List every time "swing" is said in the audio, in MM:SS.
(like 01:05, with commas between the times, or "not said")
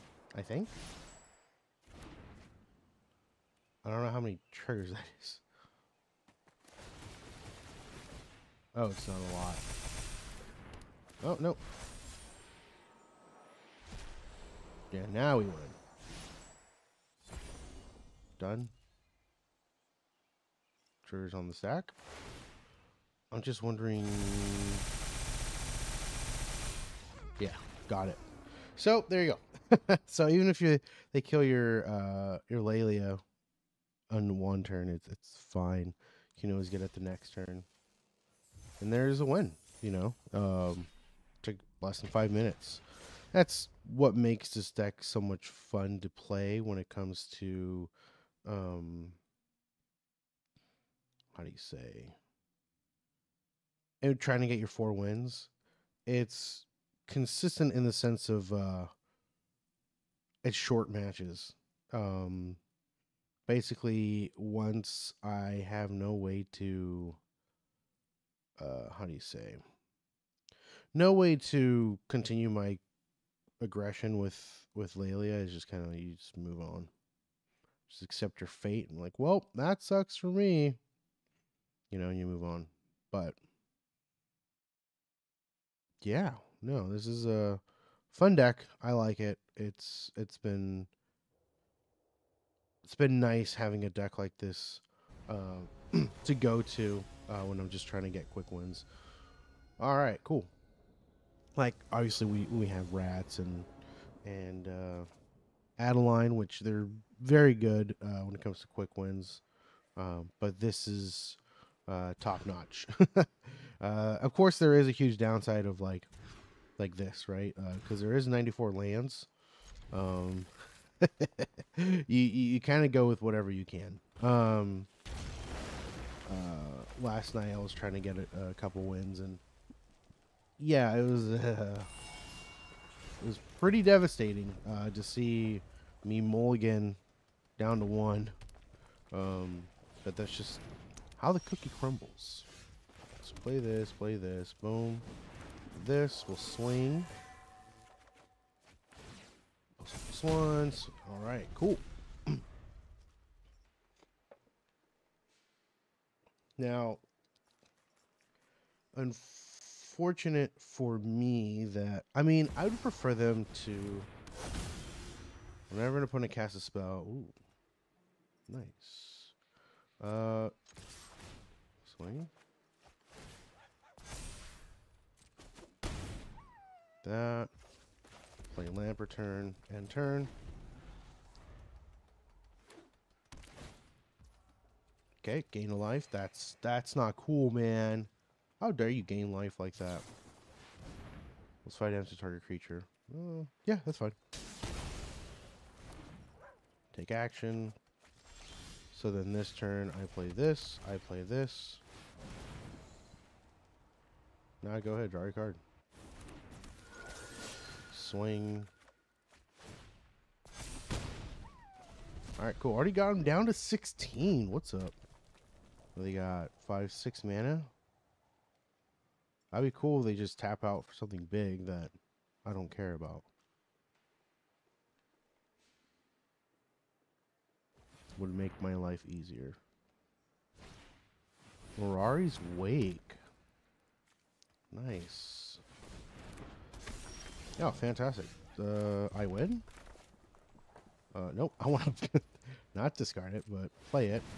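02:26, 02:51, 03:28.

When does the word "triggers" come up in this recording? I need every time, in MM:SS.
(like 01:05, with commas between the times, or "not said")
00:04, 00:21.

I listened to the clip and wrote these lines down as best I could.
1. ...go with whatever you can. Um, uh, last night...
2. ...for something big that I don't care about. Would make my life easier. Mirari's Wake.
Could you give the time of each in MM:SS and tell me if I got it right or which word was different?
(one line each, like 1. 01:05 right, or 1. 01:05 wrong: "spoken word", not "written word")
1. 02:02 right
2. 03:40 right.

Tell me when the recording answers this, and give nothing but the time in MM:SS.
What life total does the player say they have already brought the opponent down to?
03:33.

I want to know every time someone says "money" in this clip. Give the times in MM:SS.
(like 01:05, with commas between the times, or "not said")
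not said.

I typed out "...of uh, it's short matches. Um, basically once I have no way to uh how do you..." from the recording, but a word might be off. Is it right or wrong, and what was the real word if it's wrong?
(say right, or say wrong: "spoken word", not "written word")
right.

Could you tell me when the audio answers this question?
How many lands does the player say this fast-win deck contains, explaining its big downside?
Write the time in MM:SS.
01:58.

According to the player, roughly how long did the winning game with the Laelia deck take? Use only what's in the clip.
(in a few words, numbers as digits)
less than 5 minutes.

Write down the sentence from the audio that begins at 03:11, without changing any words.
Let's fight against a target creature.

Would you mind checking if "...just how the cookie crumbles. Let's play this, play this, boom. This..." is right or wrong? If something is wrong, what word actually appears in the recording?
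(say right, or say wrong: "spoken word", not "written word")
right.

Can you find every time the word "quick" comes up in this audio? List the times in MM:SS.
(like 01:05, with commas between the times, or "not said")
01:38, 01:48.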